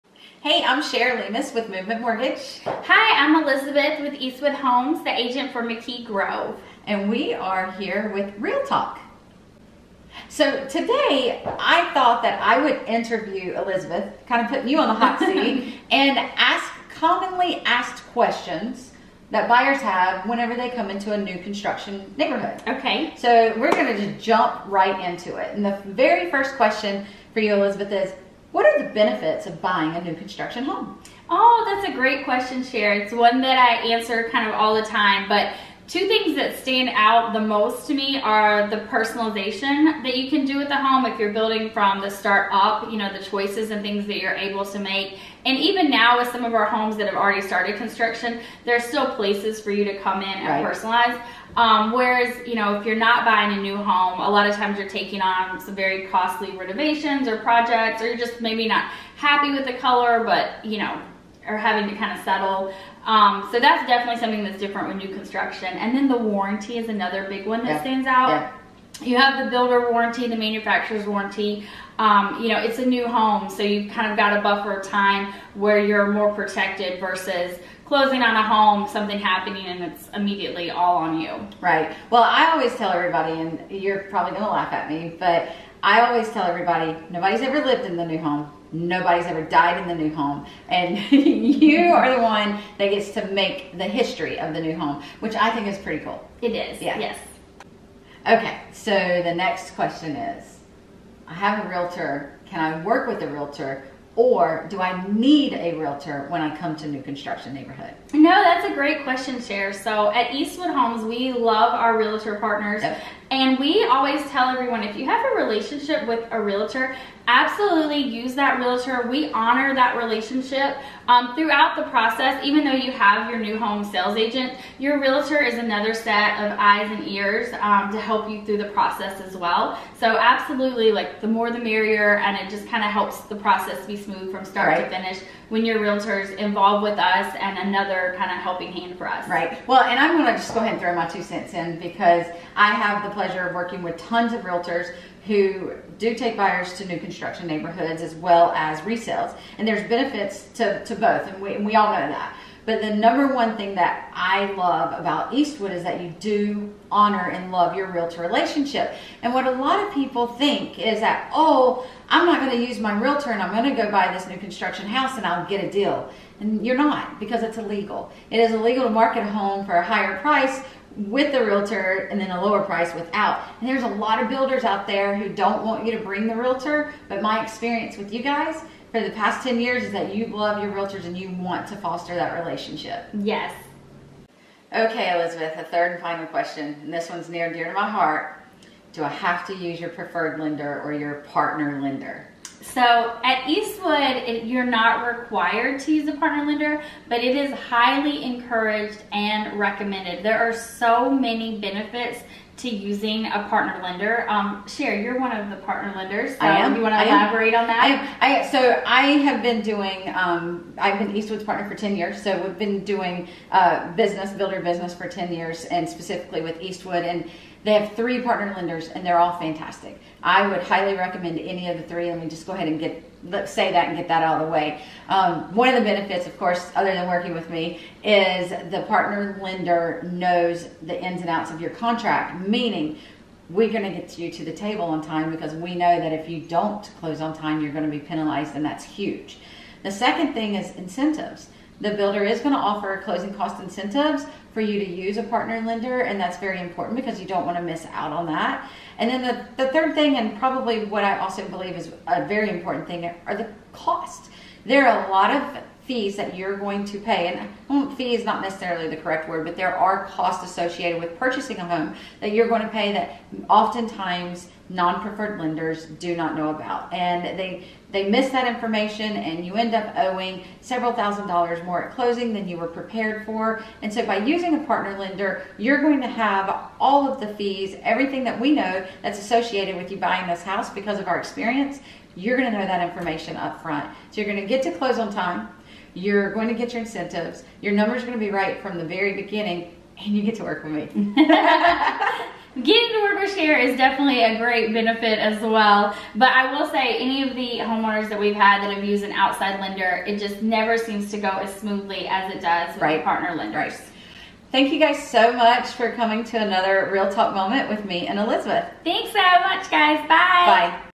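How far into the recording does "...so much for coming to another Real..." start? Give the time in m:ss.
5:05.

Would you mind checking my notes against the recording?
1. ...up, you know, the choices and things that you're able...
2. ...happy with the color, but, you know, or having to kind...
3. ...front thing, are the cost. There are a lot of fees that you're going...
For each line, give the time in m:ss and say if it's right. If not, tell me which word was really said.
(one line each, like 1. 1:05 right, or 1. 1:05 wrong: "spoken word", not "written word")
1. 0:42 right
2. 0:59 right
3. 4:12 wrong: "important", not "front".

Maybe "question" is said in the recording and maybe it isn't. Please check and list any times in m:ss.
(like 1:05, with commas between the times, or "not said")
0:18, 0:26, 0:32, 1:39, 1:49, 3:06.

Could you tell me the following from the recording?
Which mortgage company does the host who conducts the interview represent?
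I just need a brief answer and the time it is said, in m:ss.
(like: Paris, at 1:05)
Movement Mortgage, at 0:01.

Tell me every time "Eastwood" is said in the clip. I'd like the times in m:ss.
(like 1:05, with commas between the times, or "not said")
0:04, 1:50, 2:35, 3:13, 3:31, 3:36.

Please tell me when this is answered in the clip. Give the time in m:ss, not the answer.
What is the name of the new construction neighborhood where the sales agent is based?
0:05.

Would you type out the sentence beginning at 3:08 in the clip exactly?
Do I have to use your preferred lender or your partner lender?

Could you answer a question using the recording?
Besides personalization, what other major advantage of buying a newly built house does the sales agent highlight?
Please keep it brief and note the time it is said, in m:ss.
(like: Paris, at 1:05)
The warranty, at 1:06.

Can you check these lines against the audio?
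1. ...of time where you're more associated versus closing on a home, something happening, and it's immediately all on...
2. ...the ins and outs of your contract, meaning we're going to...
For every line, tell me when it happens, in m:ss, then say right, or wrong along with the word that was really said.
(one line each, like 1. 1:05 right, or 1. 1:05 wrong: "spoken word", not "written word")
1. 1:14 wrong: "protected", not "associated"
2. 3:50 right.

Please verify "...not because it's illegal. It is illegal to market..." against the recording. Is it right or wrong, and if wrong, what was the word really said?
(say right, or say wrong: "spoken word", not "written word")
right.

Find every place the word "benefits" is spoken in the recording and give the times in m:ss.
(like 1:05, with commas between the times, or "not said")
0:28, 2:29, 3:21, 3:45, 4:54.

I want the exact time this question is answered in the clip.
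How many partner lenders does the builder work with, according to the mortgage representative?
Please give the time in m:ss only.
3:37.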